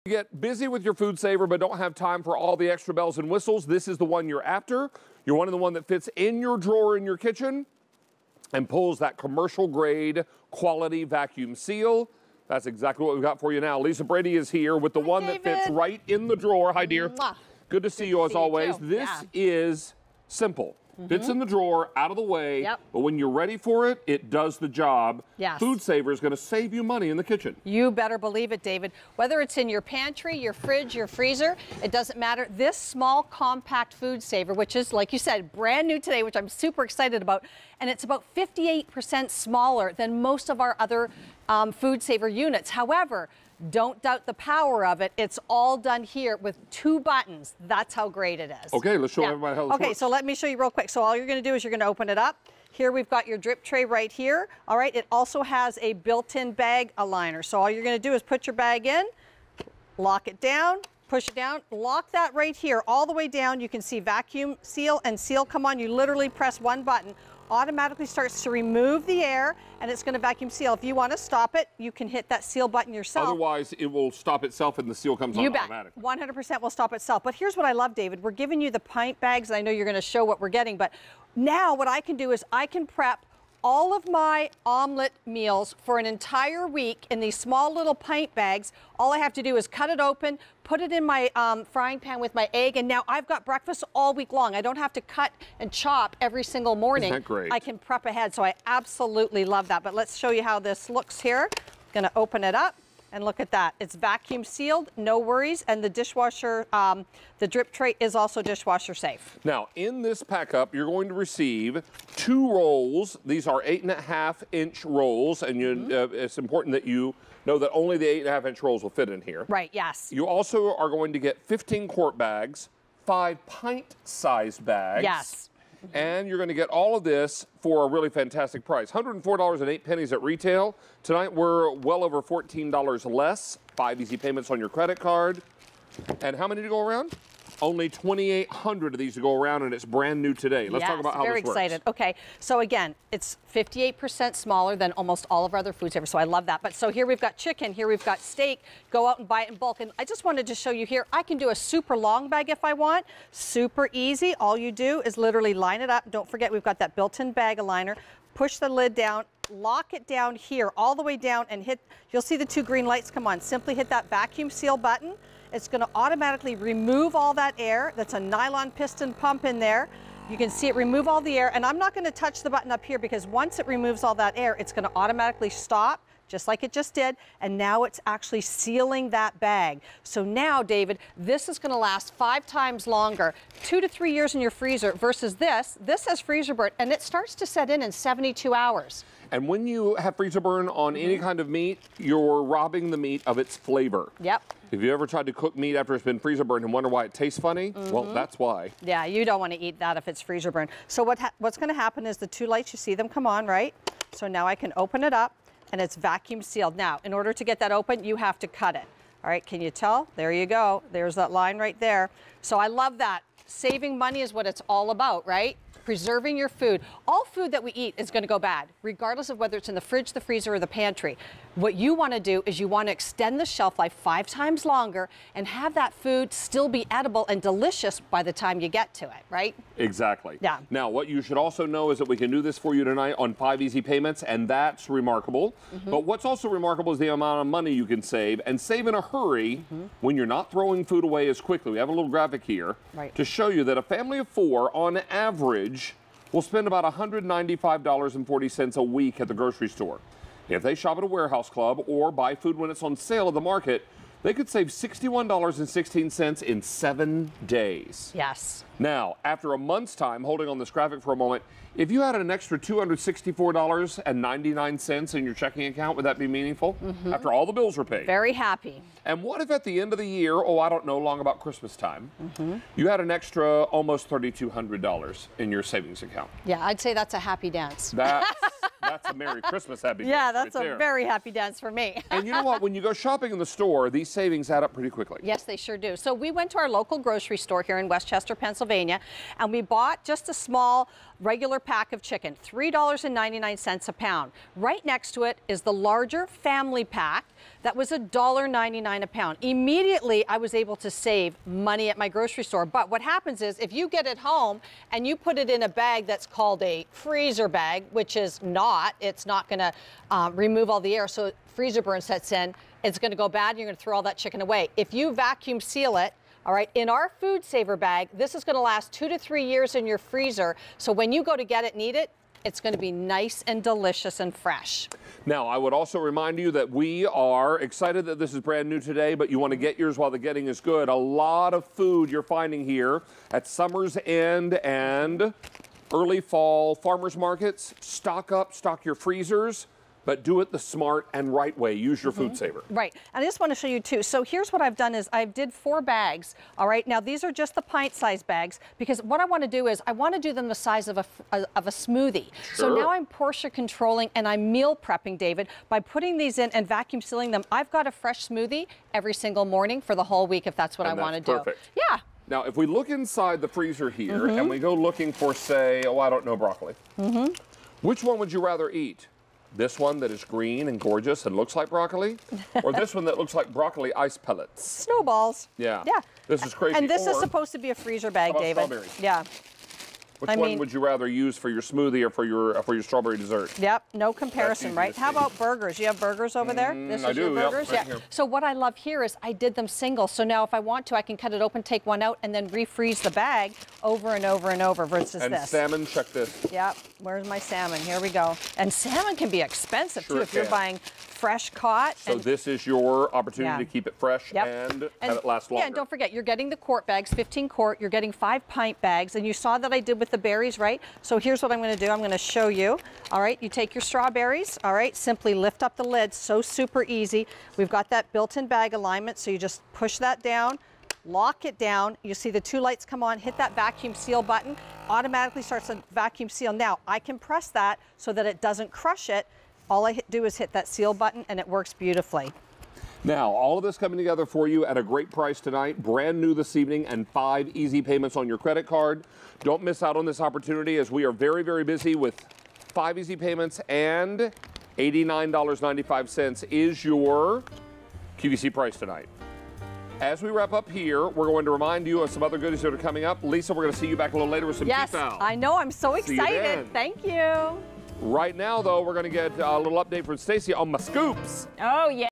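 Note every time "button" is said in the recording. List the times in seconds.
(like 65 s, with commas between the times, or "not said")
46 s, 66 s, 72 s, 164 s, 172 s, 424 s, 430 s.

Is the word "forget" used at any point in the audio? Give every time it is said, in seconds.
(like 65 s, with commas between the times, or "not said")
156 s, 405 s.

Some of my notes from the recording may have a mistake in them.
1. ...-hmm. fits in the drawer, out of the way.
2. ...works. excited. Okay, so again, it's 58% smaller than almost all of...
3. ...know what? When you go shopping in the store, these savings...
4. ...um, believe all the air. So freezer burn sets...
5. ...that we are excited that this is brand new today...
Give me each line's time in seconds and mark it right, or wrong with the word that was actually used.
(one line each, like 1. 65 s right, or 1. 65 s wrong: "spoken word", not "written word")
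1. 21 s right
2. 141 s right
3. 282 s right
4. 310 s wrong: "remove", not "believe"
5. 326 s right.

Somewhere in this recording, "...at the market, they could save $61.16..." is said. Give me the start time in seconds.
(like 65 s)
253 s.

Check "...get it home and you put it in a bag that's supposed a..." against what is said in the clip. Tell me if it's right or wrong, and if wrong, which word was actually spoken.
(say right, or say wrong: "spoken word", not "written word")
wrong: "called", not "supposed".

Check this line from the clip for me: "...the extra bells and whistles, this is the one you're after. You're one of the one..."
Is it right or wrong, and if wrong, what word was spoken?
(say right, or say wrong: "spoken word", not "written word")
right.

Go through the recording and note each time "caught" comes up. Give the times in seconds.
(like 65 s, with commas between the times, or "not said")
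401 s.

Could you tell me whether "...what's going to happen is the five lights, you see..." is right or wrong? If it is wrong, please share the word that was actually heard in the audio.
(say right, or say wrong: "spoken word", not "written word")
wrong: "two", not "five".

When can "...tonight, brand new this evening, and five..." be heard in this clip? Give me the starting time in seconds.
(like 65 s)
435 s.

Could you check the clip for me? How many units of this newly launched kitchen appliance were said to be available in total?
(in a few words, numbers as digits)
2,800.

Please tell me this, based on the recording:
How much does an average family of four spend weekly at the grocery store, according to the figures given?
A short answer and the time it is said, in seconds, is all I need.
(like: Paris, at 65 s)
$195.40, at 246 s.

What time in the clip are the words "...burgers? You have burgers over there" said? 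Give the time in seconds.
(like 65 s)
385 s.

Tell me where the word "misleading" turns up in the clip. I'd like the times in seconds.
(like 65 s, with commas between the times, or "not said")
not said.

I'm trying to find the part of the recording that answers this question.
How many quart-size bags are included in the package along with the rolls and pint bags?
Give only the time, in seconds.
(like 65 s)
121 s.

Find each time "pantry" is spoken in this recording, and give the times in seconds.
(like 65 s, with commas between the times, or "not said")
29 s, 220 s.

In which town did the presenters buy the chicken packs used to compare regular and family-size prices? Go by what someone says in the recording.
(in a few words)
West Chester, Pennsylvania.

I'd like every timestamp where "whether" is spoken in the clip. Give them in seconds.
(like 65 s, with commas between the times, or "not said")
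29 s, 219 s.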